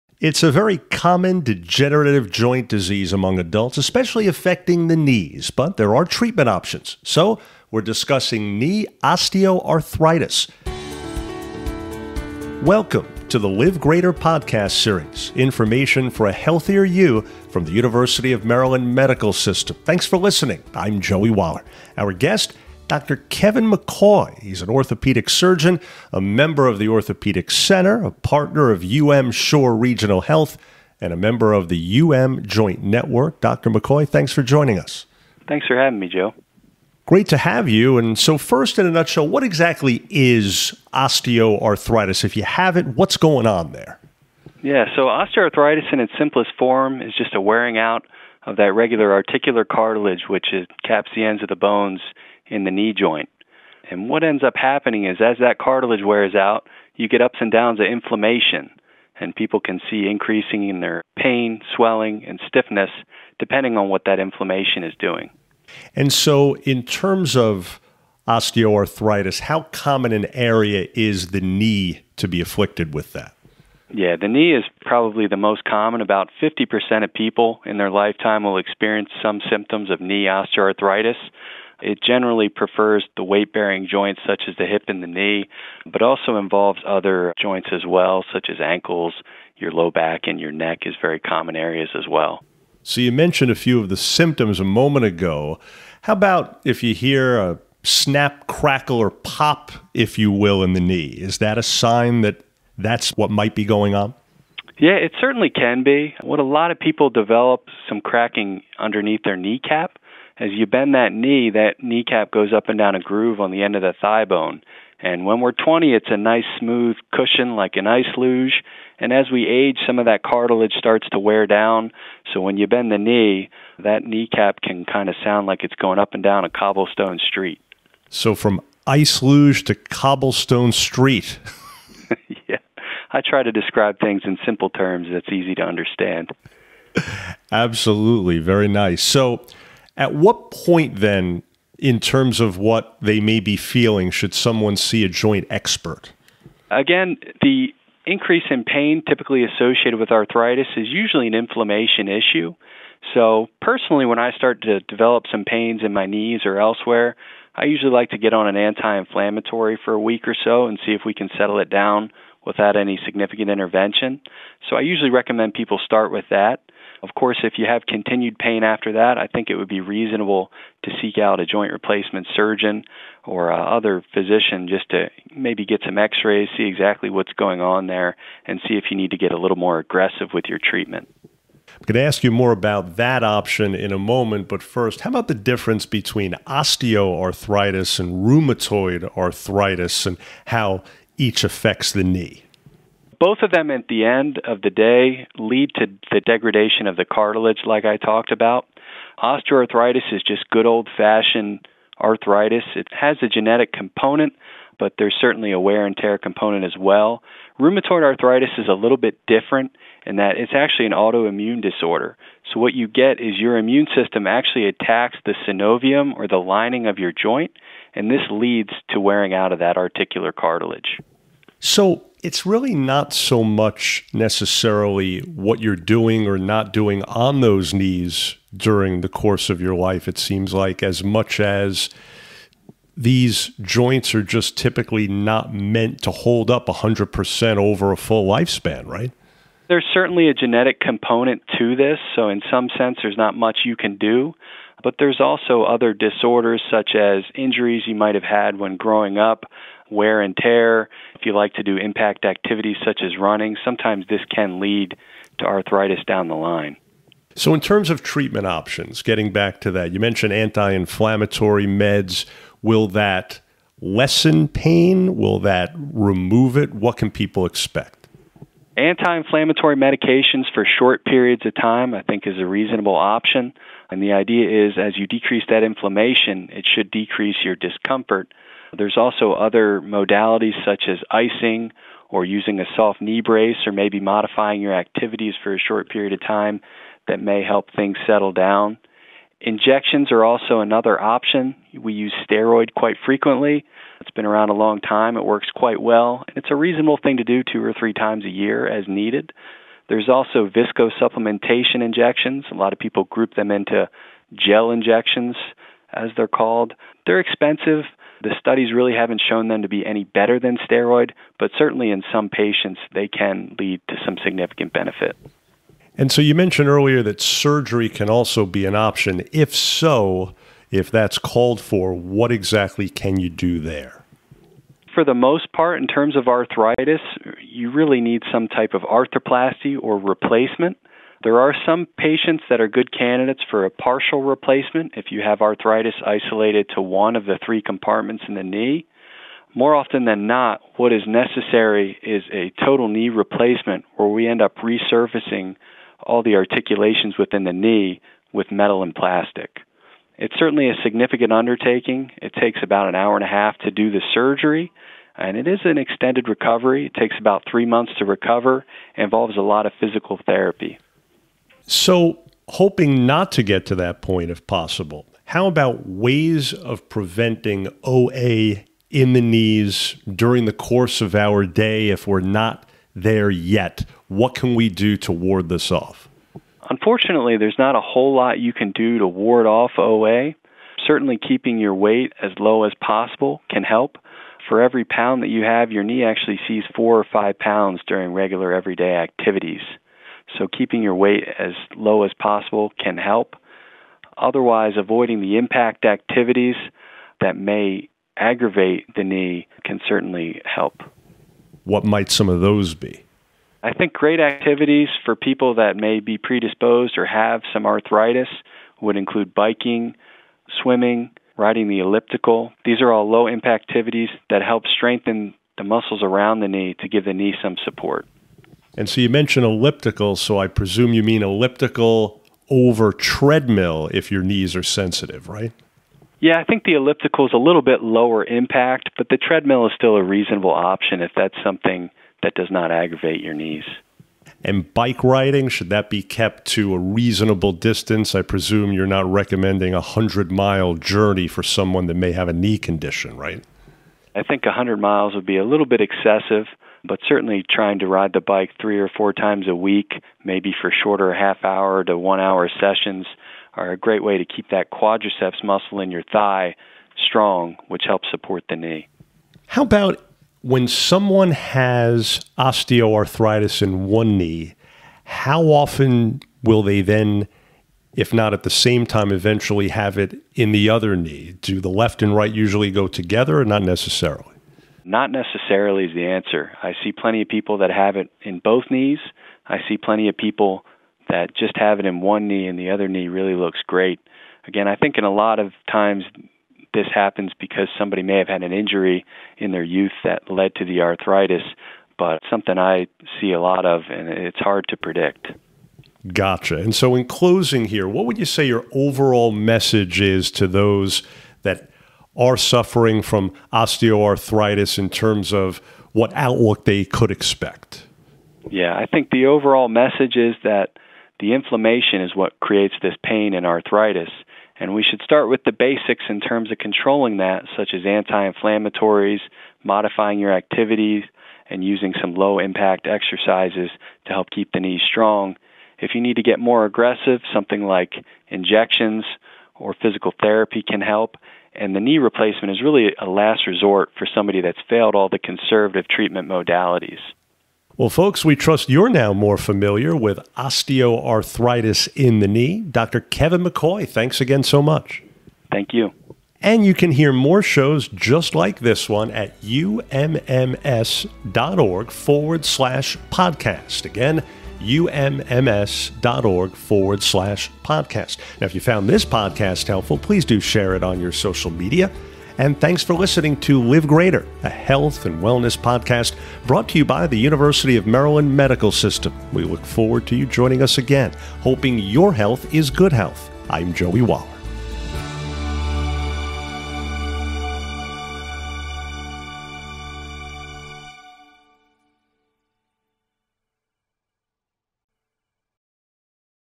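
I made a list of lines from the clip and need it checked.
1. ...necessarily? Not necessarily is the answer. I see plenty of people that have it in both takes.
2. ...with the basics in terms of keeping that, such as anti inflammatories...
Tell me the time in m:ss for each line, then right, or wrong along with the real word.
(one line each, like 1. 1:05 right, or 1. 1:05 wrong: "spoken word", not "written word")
1. 7:53 wrong: "knees", not "takes"
2. 8:35 wrong: "controlling", not "keeping".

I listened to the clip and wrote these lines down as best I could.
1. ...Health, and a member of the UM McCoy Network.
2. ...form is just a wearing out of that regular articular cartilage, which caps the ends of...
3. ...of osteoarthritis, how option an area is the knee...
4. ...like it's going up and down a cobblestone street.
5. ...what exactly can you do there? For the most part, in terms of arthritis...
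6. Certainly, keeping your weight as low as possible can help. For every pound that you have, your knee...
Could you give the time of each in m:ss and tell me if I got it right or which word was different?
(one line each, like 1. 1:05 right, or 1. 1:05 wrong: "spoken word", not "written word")
1. 0:30 wrong: "Joint", not "McCoy"
2. 0:46 right
3. 1:07 wrong: "common", not "option"
4. 2:05 right
5. 5:21 right
6. 6:20 right.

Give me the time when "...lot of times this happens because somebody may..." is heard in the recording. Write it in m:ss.
8:05.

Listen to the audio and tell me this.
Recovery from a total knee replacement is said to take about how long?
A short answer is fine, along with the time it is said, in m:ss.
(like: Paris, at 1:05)
3 months, at 5:57.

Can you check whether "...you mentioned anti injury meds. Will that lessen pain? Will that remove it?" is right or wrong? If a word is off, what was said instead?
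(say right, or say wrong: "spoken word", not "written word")
wrong: "inflammatory", not "injury".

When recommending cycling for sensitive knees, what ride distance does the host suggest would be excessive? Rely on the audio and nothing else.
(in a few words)
100 miles.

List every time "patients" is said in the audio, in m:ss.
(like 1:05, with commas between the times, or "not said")
5:12, 5:31.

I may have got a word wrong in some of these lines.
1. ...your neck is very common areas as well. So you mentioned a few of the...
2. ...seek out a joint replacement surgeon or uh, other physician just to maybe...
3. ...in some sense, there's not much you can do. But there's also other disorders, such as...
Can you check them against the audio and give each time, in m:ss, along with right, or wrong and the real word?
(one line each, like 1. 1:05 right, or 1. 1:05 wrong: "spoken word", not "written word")
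1. 1:30 right
2. 2:51 right
3. 4:02 right.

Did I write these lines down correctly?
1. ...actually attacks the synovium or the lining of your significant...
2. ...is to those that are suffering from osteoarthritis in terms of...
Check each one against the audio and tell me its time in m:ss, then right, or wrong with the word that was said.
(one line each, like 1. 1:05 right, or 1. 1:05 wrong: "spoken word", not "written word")
1. 3:34 wrong: "joint", not "significant"
2. 8:20 right.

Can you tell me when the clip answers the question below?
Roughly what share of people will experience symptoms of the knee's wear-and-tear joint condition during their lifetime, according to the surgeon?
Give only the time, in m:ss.
1:16.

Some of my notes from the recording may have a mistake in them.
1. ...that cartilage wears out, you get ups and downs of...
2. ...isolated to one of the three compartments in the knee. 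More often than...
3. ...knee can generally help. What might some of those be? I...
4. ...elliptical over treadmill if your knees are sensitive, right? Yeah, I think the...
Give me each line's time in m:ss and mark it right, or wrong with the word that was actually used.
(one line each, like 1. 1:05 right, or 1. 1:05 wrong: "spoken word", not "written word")
1. 0:55 right
2. 5:36 right
3. 6:39 wrong: "certainly", not "generally"
4. 7:01 right.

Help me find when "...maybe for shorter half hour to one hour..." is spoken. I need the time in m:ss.
7:30.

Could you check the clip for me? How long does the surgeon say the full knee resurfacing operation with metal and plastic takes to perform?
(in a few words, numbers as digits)
An hour and a half.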